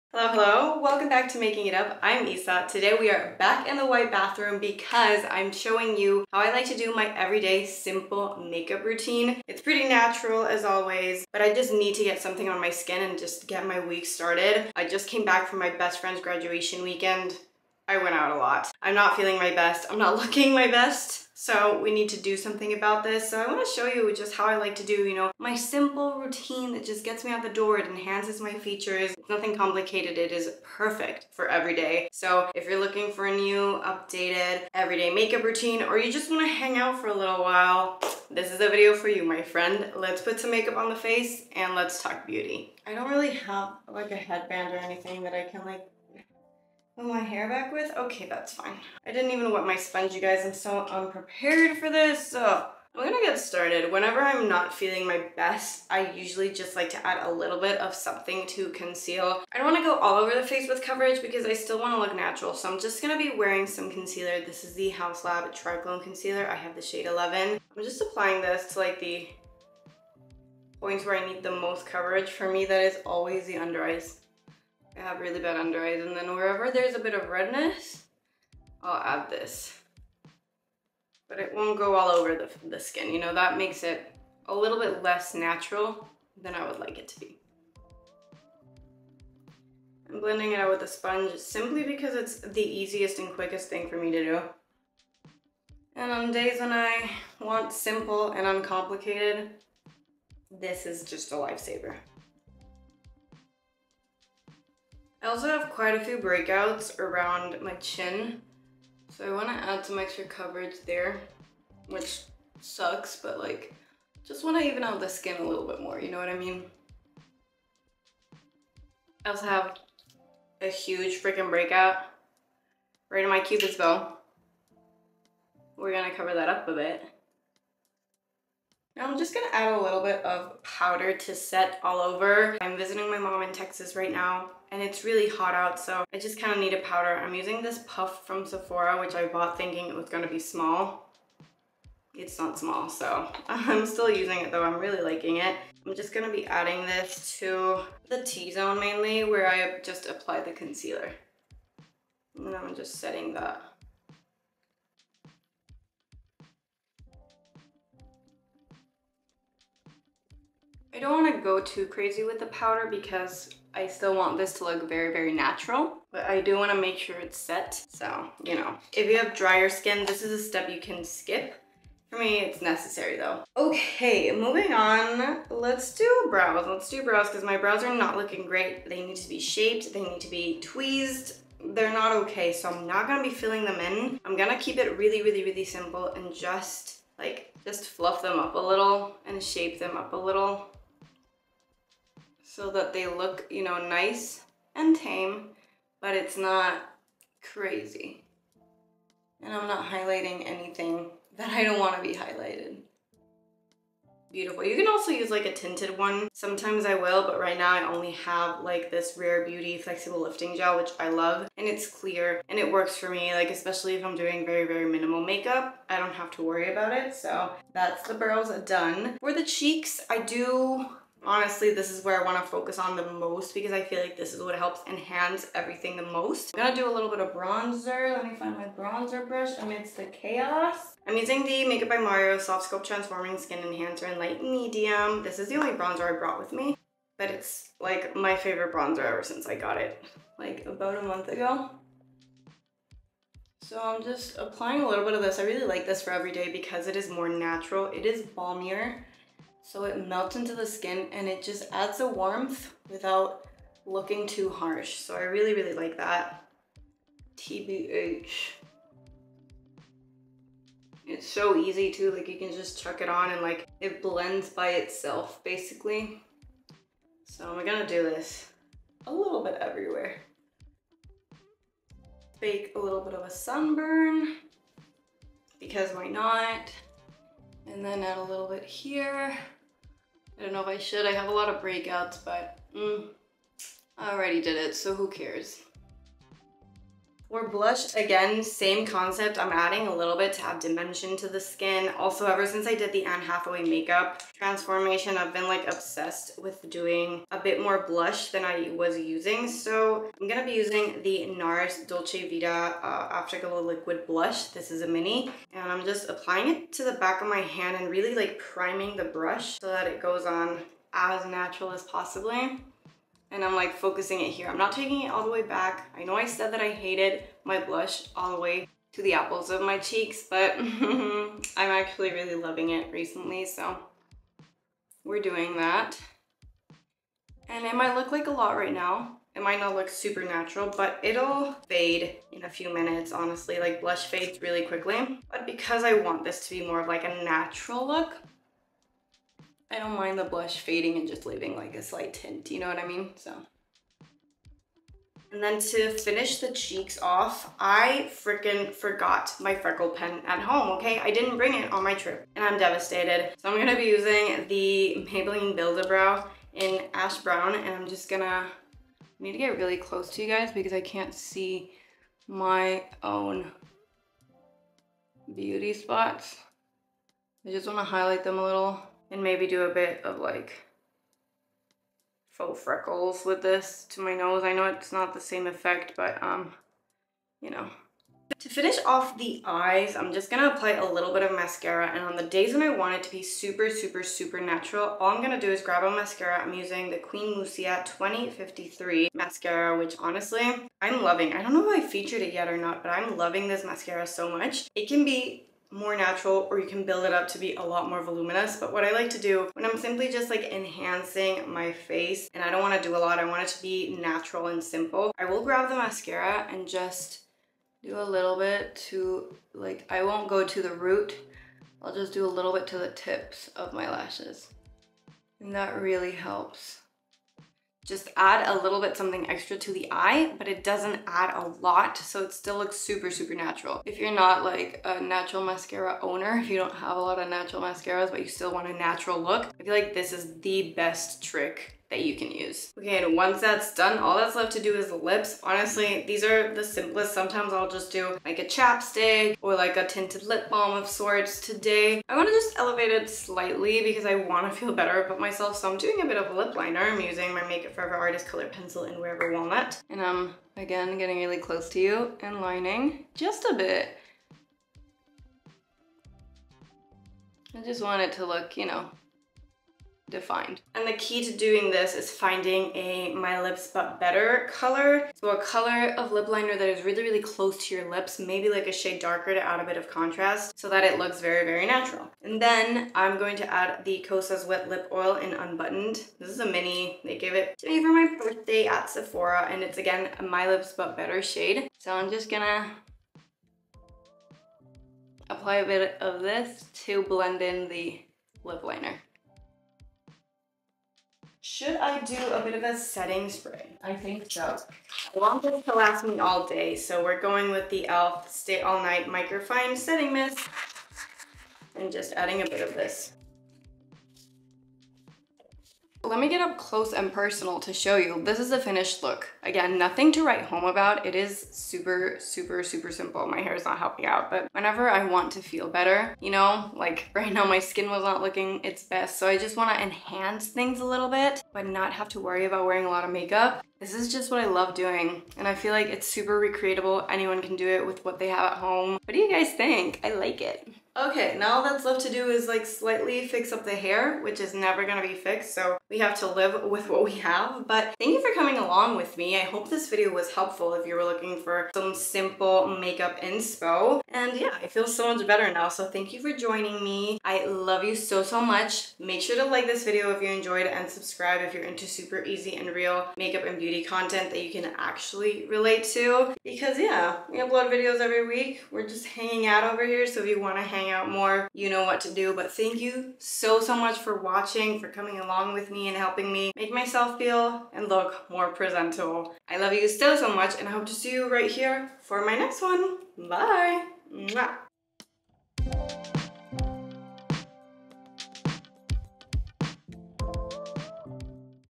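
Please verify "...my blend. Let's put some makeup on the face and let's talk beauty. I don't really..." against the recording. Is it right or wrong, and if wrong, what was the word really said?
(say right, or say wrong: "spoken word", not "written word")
wrong: "friend", not "blend".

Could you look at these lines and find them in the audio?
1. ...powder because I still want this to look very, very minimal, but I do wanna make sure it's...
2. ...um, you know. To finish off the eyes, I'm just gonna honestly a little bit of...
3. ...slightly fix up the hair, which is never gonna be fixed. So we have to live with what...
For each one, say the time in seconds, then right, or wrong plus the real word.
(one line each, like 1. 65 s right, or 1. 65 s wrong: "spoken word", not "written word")
1. 162 s wrong: "natural", not "minimal"
2. 376 s wrong: "apply", not "honestly"
3. 532 s right.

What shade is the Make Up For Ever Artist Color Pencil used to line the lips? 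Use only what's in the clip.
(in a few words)
Wherever Walnut.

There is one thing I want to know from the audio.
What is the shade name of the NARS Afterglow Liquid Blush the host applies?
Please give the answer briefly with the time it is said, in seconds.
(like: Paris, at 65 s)
Dolce Vita, at 301 s.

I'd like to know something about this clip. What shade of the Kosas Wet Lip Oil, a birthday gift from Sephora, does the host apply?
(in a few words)
Unbuttoned.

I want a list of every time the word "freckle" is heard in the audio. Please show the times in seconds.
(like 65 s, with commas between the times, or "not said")
349 s, 372 s.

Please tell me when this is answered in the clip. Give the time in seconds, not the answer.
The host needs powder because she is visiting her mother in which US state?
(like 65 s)
133 s.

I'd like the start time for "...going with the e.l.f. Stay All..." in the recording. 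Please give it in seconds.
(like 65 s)
497 s.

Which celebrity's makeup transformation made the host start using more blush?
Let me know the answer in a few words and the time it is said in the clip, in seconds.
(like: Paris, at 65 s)
Anne Hathaway, at 293 s.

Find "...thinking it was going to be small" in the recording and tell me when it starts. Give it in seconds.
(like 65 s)
139 s.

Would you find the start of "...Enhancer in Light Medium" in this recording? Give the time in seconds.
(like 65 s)
233 s.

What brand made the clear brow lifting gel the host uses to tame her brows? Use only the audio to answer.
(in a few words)
Rare Beauty.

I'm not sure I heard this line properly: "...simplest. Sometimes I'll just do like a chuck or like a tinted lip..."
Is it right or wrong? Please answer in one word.
wrong.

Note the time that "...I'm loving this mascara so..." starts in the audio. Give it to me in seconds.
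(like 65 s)
392 s.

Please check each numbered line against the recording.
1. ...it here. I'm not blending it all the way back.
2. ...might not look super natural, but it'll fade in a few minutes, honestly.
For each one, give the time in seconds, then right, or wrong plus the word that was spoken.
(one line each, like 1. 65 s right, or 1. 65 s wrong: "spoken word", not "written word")
1. 314 s wrong: "taking", not "blending"
2. 329 s right.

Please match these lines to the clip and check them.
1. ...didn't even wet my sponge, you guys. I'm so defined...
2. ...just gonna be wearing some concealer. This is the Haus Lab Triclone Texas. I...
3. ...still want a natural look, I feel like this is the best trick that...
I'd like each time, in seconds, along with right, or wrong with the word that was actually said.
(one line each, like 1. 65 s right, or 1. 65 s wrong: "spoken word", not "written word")
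1. 49 s wrong: "unprepared", not "defined"
2. 62 s wrong: "Concealer", not "Texas"
3. 428 s right.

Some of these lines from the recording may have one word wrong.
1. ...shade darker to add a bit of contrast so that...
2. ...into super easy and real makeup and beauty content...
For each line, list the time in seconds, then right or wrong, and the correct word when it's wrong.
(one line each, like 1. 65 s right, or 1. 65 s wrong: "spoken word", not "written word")
1. 468 s right
2. 551 s right.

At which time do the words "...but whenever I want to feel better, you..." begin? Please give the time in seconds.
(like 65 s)
514 s.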